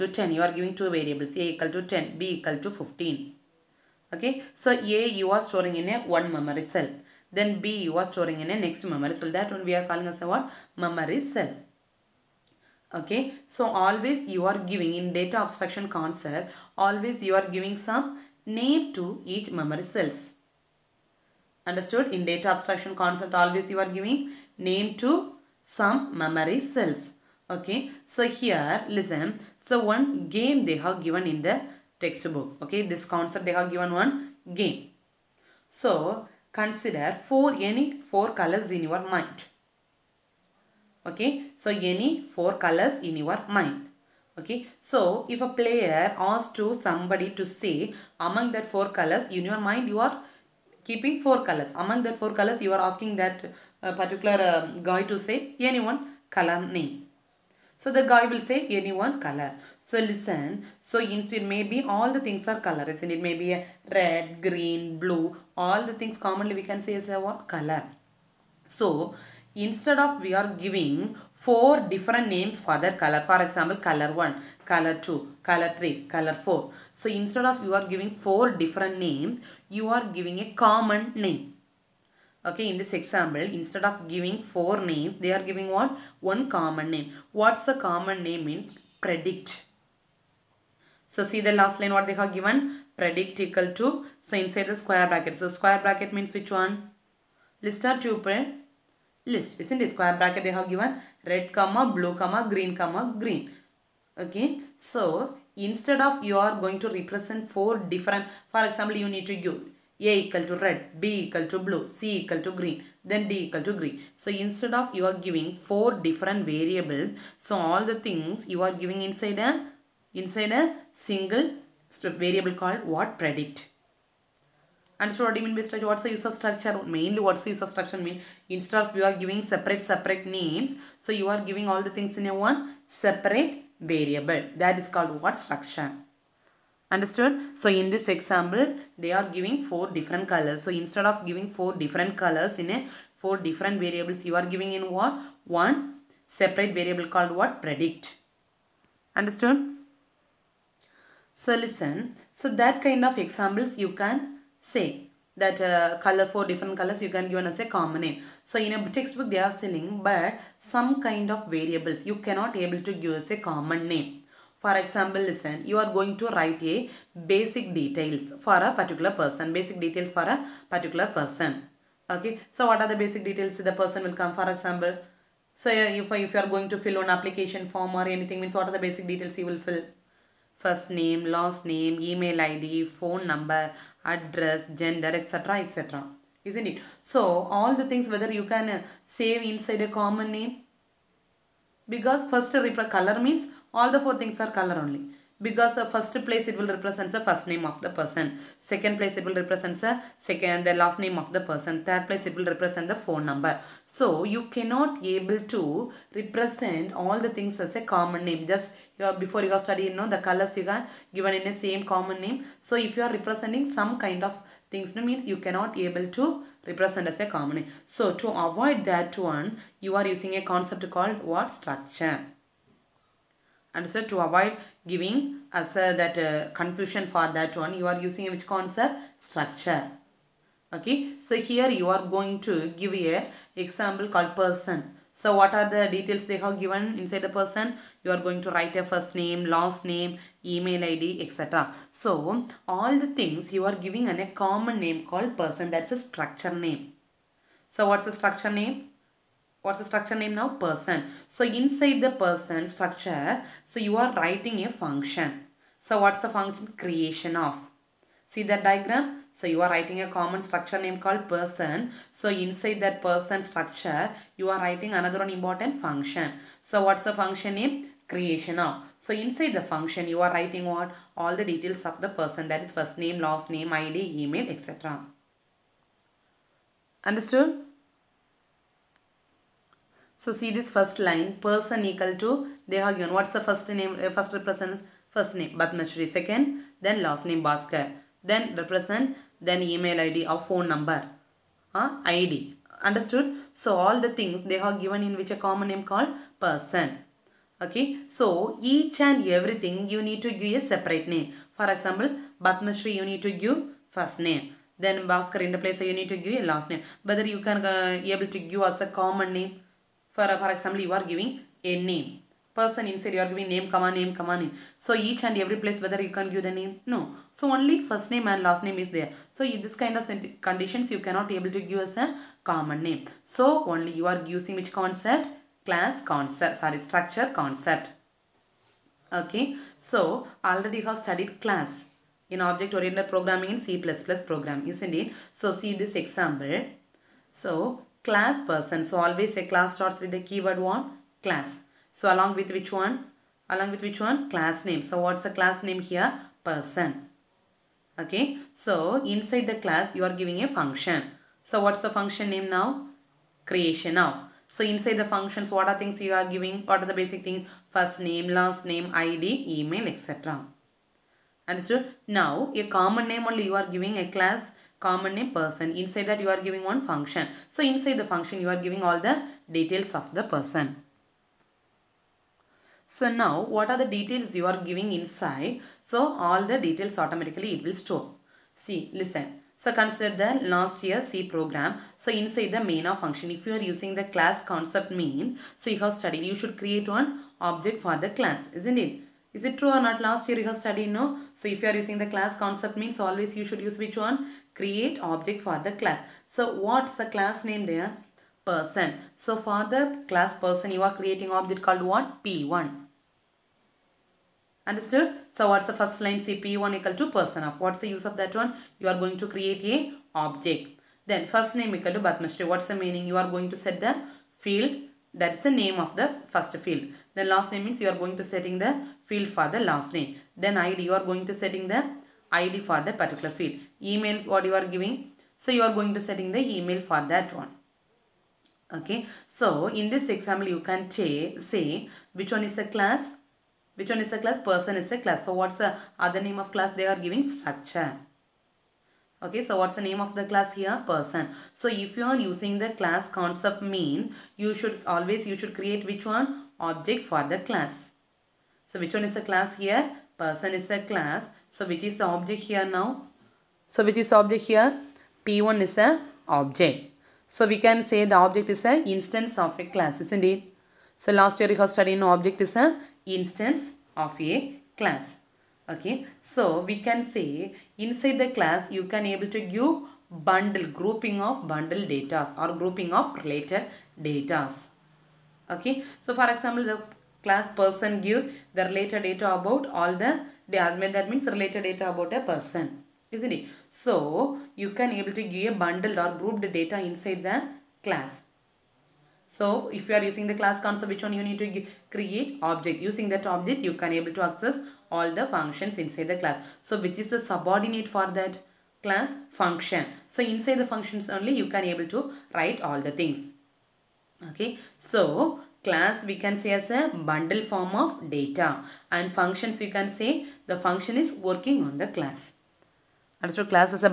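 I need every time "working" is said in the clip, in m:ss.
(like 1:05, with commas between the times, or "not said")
8:31.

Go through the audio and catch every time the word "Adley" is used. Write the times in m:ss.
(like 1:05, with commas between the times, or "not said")
not said.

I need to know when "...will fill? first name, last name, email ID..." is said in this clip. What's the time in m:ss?
2:59.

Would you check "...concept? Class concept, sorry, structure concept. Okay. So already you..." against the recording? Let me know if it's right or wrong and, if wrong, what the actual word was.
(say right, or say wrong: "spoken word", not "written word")
right.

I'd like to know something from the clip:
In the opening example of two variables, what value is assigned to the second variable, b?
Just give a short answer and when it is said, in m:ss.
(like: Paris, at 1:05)
15, at 0:02.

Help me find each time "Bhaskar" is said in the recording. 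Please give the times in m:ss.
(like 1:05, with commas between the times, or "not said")
4:47, 5:05.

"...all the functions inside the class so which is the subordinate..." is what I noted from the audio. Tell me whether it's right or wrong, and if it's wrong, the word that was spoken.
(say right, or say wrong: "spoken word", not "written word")
right.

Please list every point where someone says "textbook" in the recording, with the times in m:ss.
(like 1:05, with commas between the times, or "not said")
0:31, 2:38.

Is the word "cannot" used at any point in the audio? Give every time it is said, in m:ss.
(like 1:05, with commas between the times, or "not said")
2:42, 3:24, 3:35, 5:20.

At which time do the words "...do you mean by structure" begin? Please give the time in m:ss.
2:05.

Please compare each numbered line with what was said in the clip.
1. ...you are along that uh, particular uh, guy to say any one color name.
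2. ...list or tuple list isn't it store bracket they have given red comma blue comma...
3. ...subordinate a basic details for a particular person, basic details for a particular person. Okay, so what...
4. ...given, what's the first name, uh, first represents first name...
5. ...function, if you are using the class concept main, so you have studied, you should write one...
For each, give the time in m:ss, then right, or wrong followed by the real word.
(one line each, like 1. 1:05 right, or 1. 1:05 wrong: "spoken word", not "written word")
1. 0:52 wrong: "asking", not "along"
2. 1:37 wrong: "square", not "store"
3. 2:46 wrong: "write", not "subordinate"
4. 4:42 right
5. 6:23 wrong: "create", not "write".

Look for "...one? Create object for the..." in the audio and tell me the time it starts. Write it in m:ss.
6:33.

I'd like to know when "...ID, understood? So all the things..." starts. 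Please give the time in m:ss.
4:52.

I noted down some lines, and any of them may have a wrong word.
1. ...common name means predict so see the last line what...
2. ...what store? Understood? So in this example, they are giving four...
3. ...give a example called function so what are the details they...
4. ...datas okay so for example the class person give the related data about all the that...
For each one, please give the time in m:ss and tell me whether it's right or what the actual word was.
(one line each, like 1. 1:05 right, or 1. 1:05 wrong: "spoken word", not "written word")
1. 1:27 right
2. 2:15 wrong: "structure", not "store"
3. 3:52 wrong: "person", not "function"
4. 7:54 right.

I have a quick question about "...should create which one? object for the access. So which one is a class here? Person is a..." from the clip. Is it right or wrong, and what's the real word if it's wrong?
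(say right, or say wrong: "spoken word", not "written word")
wrong: "class", not "access".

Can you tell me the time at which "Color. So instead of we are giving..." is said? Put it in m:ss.
1:07.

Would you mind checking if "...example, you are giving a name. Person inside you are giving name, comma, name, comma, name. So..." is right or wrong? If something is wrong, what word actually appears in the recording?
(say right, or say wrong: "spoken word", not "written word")
right.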